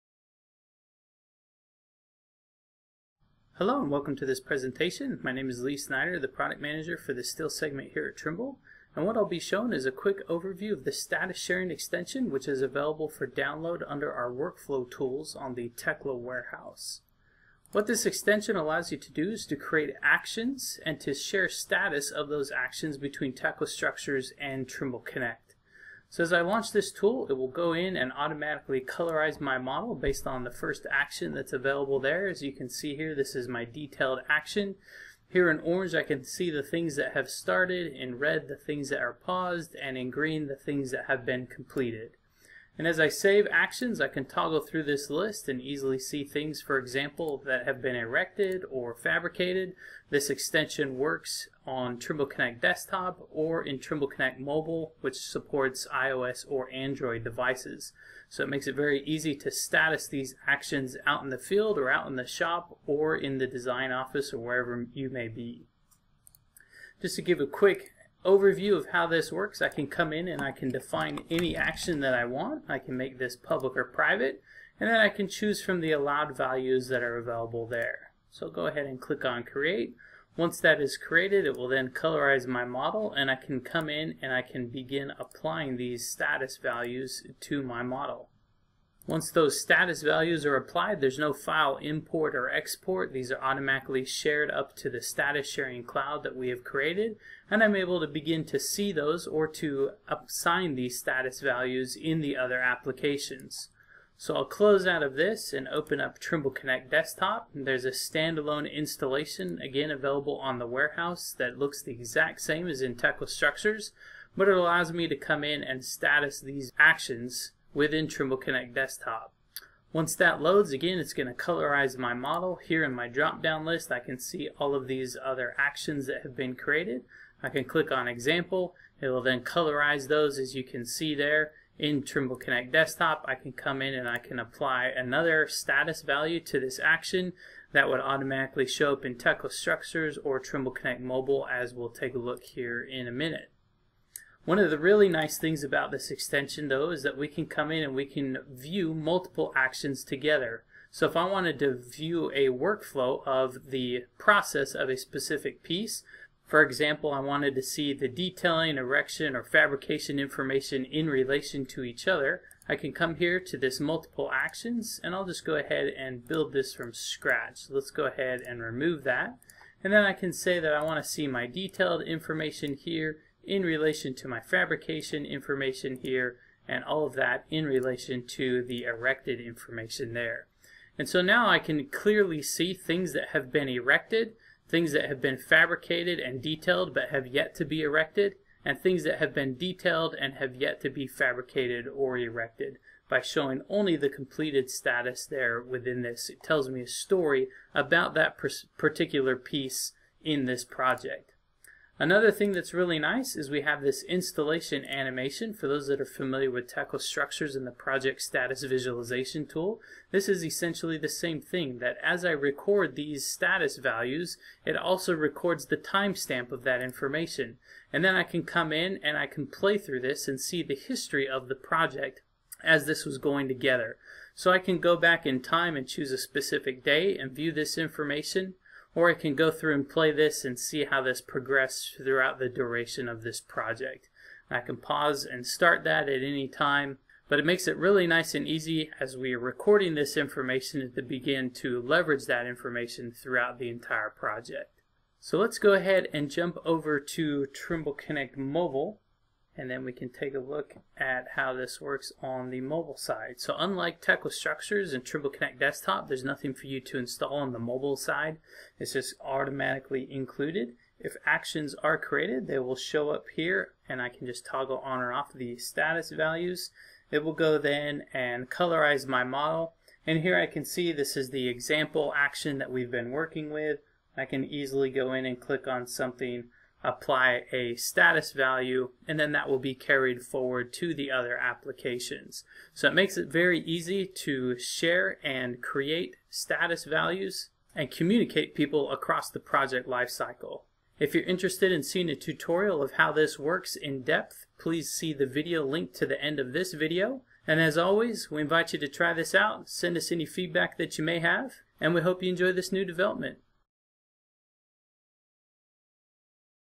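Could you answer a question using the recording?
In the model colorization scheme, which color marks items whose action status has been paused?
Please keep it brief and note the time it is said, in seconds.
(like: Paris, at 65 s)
Red, at 38 s.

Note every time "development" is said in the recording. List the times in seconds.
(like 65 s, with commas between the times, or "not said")
302 s.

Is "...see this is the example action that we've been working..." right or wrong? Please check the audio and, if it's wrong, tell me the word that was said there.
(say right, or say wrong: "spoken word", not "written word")
right.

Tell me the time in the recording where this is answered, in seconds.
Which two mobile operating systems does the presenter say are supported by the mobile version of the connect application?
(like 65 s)
55 s.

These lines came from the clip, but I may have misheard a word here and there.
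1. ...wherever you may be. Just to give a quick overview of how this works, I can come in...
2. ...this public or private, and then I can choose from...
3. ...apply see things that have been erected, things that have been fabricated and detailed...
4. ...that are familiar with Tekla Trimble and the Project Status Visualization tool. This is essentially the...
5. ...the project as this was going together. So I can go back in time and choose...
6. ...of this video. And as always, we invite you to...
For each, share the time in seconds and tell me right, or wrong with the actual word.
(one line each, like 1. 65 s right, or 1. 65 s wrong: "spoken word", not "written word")
1. 64 s right
2. 73 s right
3. 181 s wrong: "clearly", not "apply"
4. 205 s wrong: "Structures", not "Trimble"
5. 221 s right
6. 296 s right.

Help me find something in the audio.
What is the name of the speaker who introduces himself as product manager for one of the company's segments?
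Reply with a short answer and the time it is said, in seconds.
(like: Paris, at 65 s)
Lee Snyder, at 5 s.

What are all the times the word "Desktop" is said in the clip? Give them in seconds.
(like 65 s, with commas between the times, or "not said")
52 s, 106 s, 118 s, 132 s, 255 s.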